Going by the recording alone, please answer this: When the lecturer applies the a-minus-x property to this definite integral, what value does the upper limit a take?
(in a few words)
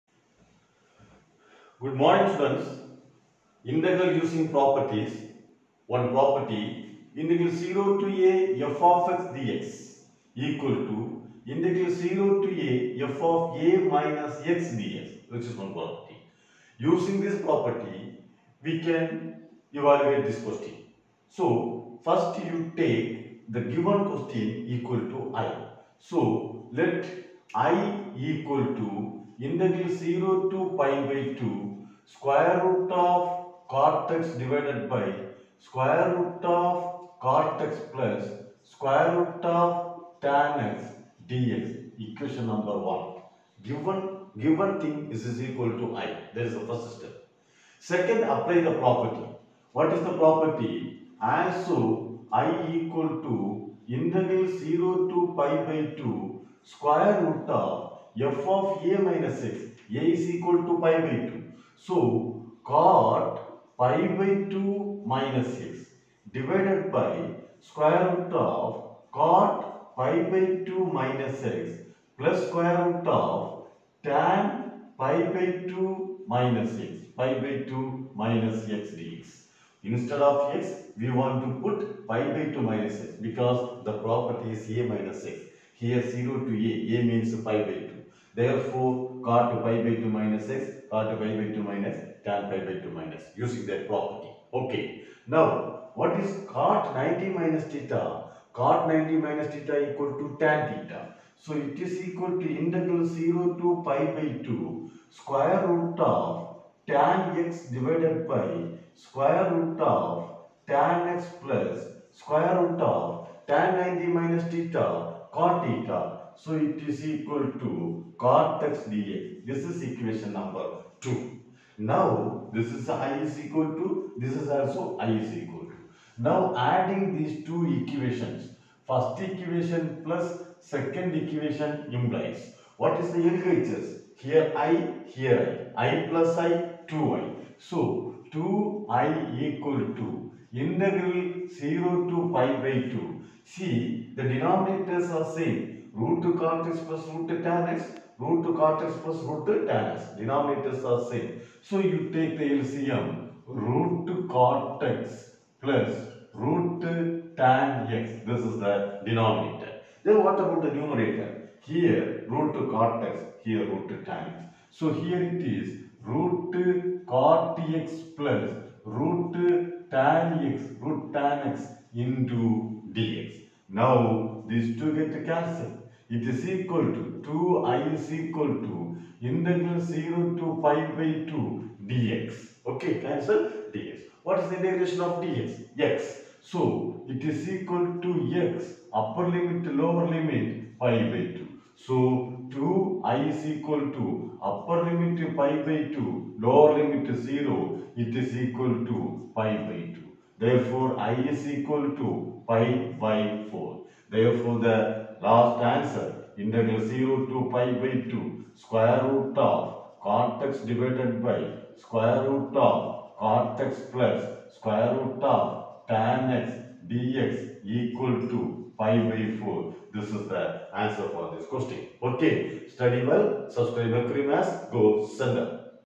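pi/2.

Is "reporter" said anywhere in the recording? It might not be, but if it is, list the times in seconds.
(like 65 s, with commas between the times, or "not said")
not said.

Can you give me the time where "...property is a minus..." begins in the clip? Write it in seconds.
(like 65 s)
84 s.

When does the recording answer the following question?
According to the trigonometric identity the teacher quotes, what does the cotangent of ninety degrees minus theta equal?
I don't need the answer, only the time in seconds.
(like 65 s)
100 s.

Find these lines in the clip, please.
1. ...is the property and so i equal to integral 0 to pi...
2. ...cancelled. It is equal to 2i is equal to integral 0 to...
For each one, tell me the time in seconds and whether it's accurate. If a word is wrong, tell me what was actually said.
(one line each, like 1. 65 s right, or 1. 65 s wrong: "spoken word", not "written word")
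1. 49 s right
2. 175 s right.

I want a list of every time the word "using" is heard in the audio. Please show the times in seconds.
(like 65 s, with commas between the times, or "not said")
4 s, 16 s, 93 s.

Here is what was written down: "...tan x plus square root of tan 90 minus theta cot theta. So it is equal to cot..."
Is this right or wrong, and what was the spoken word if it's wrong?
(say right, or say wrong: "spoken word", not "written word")
right.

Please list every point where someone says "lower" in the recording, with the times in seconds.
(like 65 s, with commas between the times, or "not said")
189 s, 196 s.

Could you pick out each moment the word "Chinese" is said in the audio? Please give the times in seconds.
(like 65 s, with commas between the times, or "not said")
not said.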